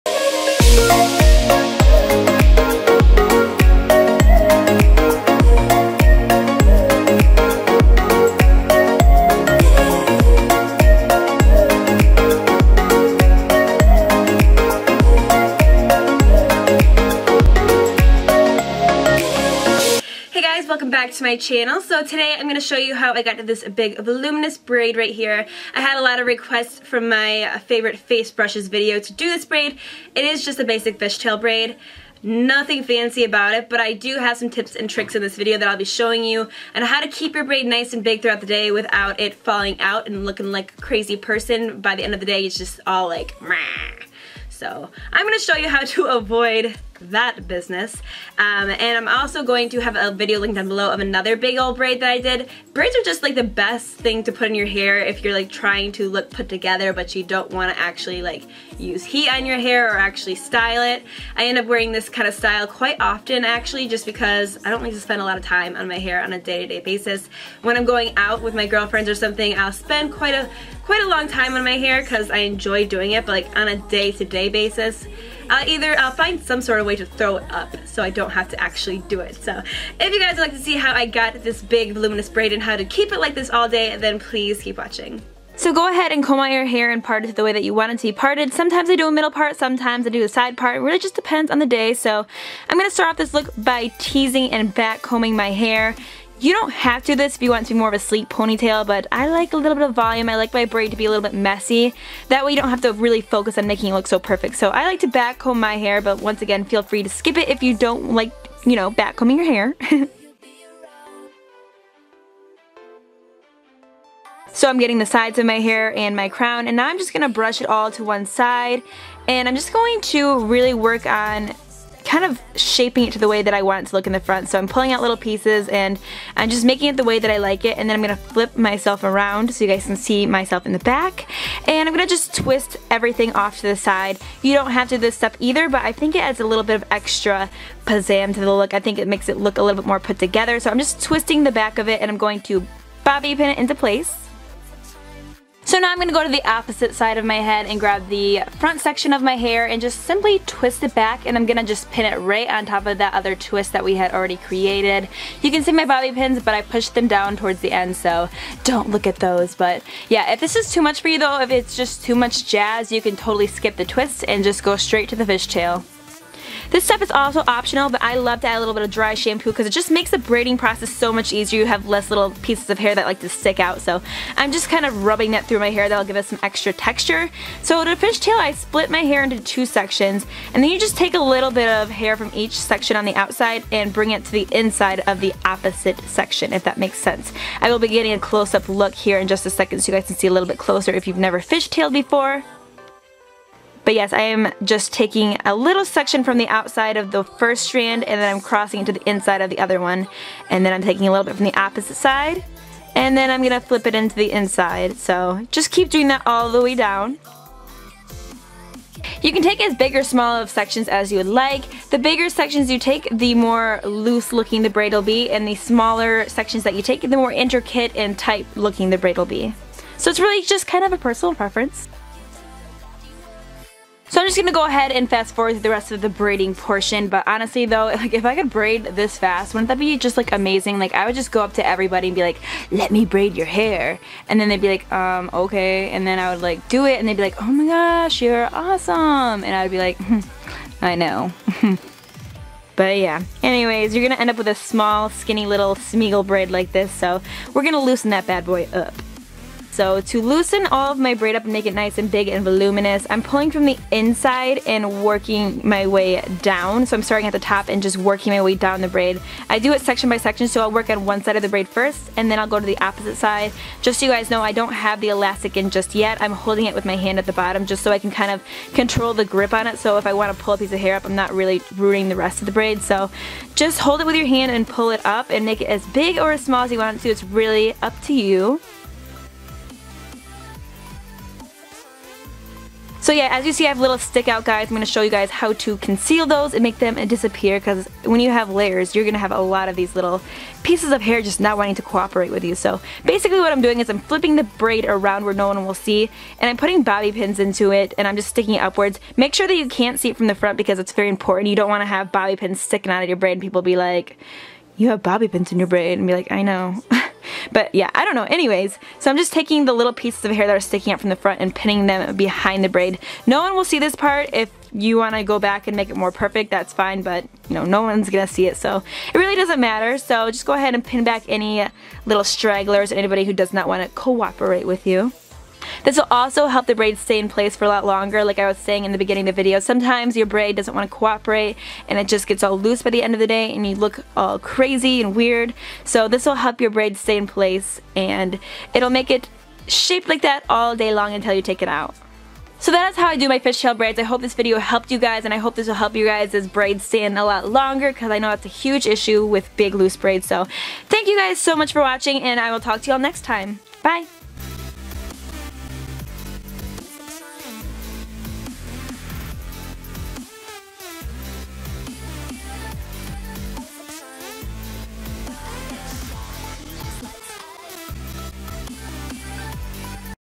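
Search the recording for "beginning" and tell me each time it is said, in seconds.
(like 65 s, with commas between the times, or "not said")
328 s.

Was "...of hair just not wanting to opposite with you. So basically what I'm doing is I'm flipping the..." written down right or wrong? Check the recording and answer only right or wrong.
wrong.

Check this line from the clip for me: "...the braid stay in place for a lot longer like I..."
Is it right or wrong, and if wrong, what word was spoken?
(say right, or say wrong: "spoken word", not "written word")
right.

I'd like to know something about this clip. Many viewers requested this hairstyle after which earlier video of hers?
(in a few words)
favorite face brushes.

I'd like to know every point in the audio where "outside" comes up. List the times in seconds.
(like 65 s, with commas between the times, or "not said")
183 s, 196 s.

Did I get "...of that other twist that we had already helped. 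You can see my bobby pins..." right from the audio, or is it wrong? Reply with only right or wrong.
wrong.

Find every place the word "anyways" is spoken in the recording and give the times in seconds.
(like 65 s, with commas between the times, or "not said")
243 s, 308 s.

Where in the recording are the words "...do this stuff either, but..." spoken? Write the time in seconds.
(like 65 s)
134 s.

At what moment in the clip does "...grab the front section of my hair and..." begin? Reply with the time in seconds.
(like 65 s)
147 s.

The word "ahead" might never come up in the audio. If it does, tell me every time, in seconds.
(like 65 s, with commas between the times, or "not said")
85 s, 224 s, 320 s.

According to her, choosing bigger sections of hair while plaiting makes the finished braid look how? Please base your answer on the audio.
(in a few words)
more loose.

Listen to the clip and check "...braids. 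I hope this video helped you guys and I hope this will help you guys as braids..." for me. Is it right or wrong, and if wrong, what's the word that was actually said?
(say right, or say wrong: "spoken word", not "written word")
right.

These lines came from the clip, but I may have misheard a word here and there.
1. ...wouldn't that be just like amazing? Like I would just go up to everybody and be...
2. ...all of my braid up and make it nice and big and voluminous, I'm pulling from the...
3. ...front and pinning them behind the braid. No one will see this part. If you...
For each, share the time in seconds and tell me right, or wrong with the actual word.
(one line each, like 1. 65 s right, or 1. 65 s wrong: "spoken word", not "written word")
1. 229 s right
2. 250 s right
3. 311 s right.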